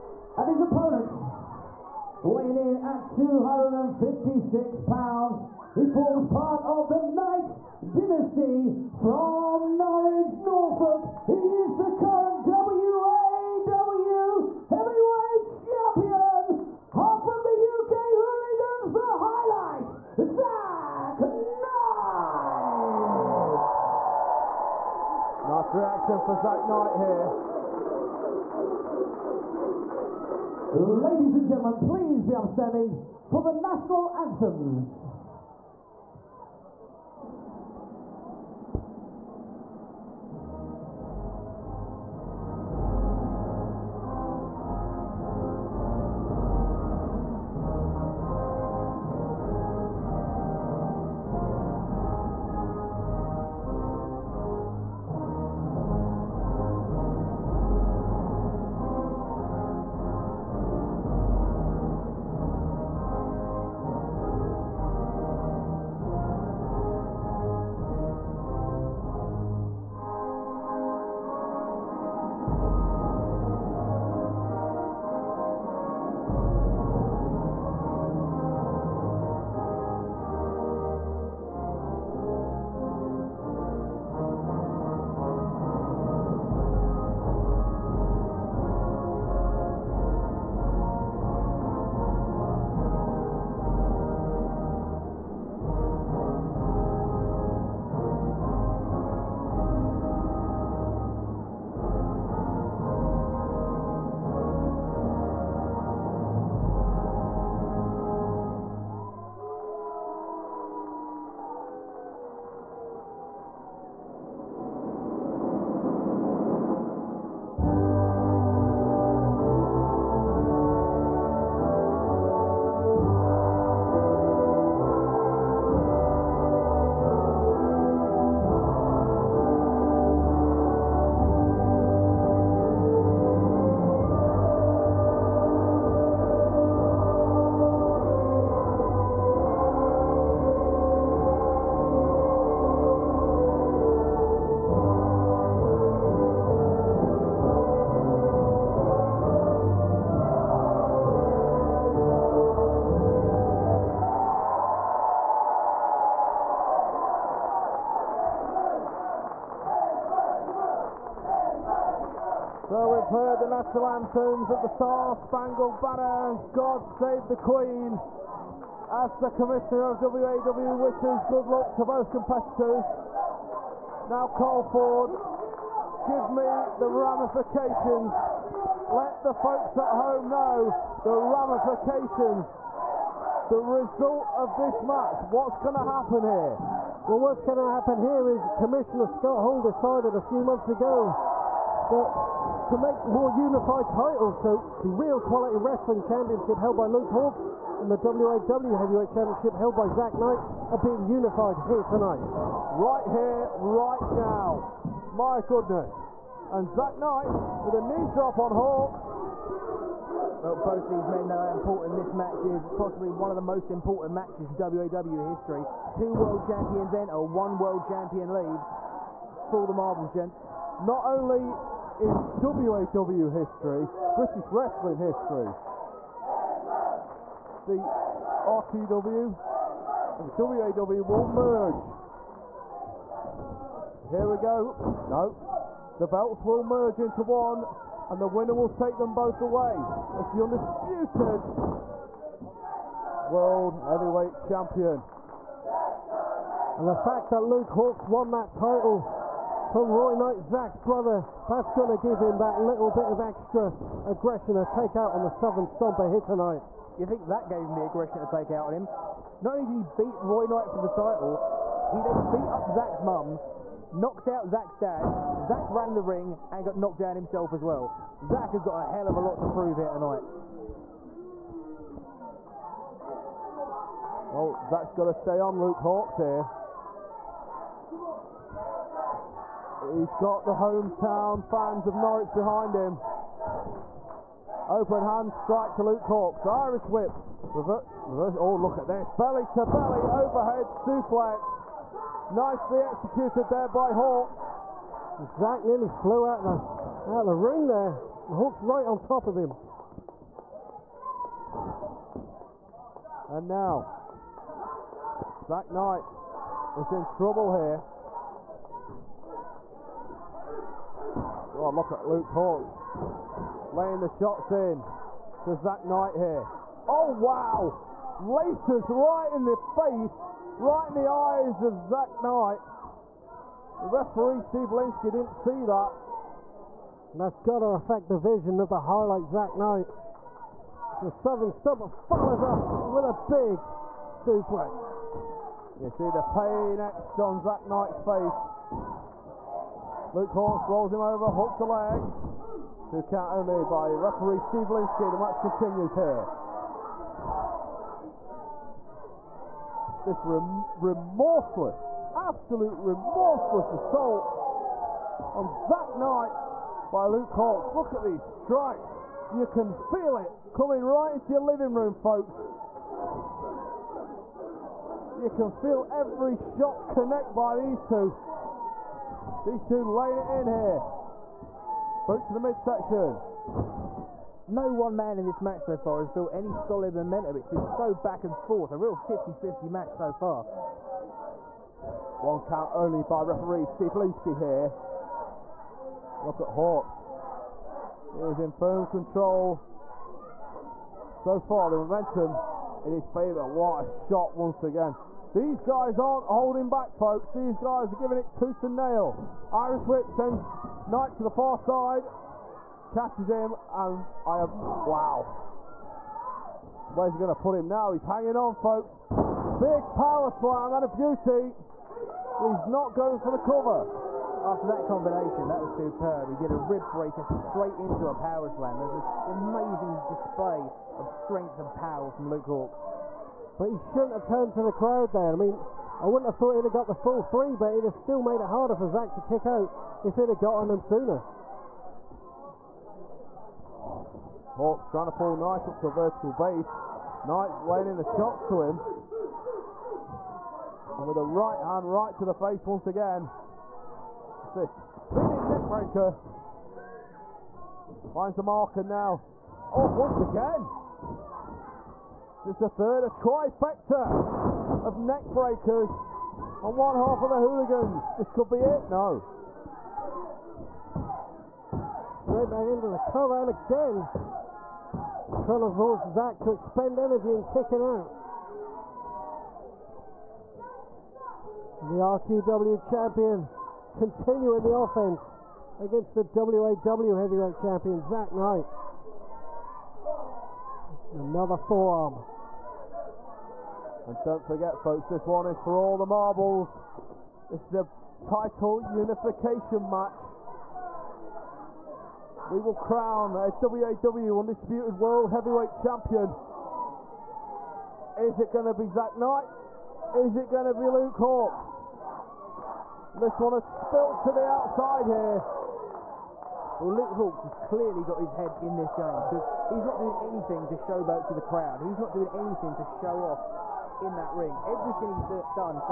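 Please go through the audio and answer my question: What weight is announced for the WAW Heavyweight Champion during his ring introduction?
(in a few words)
256 pounds.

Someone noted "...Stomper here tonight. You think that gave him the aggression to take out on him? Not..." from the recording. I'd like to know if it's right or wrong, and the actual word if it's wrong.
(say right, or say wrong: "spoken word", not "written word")
right.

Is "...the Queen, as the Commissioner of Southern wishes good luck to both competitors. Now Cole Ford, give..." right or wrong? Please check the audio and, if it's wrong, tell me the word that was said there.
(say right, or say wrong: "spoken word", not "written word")
wrong: "WAW", not "Southern".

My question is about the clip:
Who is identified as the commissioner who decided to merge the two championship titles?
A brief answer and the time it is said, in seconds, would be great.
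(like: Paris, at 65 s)
Scott Hall, at 189 s.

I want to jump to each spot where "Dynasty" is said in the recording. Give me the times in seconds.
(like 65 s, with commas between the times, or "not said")
7 s.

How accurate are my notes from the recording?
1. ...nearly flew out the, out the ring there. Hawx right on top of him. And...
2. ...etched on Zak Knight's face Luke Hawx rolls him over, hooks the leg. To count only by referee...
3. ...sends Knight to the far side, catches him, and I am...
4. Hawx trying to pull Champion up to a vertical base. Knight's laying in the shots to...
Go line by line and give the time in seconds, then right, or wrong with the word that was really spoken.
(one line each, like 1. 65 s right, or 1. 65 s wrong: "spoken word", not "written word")
1. 295 s right
2. 336 s right
3. 400 s right
4. 434 s wrong: "Knight", not "Champion".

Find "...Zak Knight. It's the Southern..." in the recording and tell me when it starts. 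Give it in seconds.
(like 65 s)
329 s.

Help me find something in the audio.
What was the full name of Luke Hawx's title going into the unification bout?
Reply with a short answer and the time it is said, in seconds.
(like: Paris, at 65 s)
Real Quality Wrestling Championship, at 194 s.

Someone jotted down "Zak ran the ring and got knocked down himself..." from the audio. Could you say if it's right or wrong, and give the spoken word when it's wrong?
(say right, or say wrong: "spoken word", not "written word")
right.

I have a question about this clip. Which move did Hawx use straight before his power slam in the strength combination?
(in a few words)
rib breaker.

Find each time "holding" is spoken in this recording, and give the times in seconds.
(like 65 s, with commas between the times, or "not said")
396 s.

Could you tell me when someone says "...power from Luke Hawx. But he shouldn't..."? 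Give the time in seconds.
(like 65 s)
421 s.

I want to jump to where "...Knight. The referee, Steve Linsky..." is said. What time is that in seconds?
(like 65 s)
322 s.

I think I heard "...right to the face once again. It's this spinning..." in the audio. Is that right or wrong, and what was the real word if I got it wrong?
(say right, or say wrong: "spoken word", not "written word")
right.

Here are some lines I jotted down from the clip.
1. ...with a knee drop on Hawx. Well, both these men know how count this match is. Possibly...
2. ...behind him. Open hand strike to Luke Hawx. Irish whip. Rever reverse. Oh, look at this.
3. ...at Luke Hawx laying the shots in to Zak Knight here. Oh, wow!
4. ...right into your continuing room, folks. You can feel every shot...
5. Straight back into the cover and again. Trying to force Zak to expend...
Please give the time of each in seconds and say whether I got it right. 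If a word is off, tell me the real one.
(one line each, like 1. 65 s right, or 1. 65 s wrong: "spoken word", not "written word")
1. 207 s wrong: "important", not "count"
2. 282 s right
3. 311 s right
4. 360 s wrong: "living", not "continuing"
5. 462 s right.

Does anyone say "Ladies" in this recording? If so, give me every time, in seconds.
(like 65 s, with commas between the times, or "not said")
30 s.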